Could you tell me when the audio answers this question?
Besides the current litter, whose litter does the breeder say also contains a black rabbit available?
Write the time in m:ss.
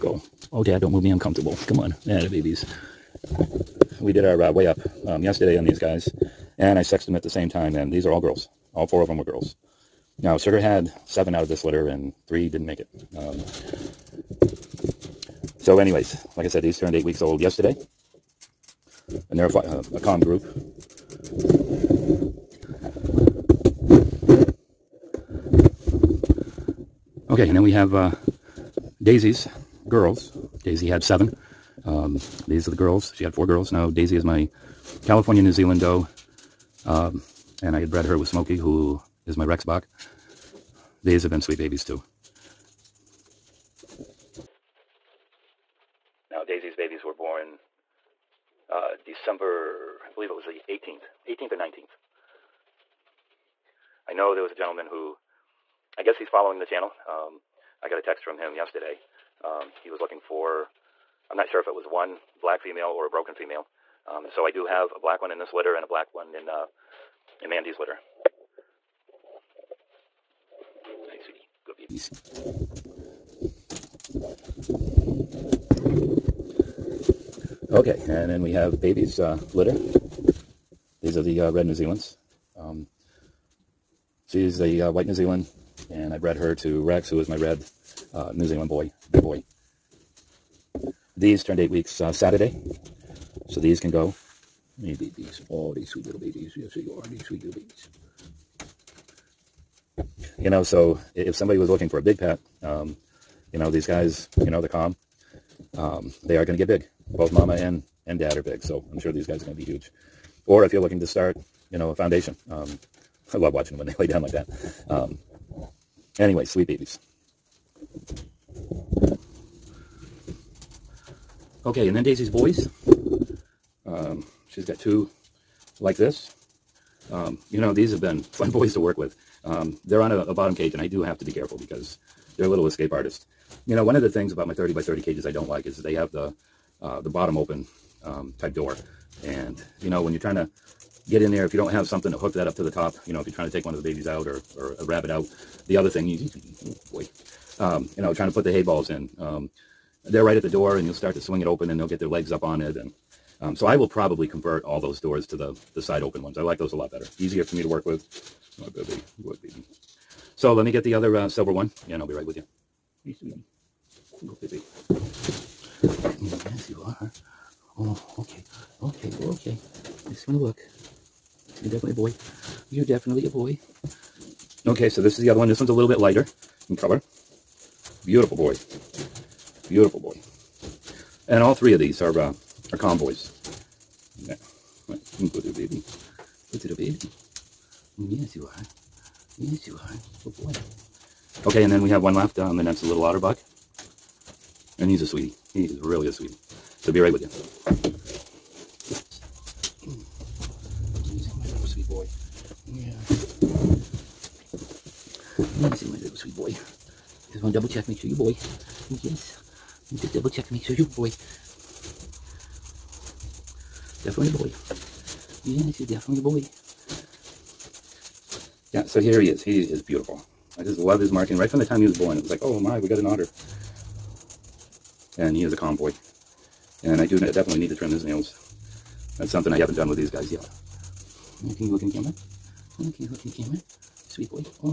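1:07.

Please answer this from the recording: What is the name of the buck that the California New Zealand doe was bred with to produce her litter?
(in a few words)
Smokey.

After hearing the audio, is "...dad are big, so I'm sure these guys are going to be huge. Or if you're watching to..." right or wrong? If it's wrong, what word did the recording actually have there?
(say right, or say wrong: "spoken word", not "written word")
wrong: "looking", not "watching".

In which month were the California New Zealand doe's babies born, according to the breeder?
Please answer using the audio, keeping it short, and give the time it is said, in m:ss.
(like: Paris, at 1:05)
December, at 0:48.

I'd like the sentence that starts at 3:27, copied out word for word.
Just want to double check, make sure you boy.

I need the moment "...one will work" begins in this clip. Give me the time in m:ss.
2:50.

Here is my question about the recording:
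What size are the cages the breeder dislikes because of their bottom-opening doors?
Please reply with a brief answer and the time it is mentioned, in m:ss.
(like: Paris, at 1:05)
30 by 30, at 2:14.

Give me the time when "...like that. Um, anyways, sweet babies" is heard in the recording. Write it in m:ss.
1:54.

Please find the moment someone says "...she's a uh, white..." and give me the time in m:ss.
1:24.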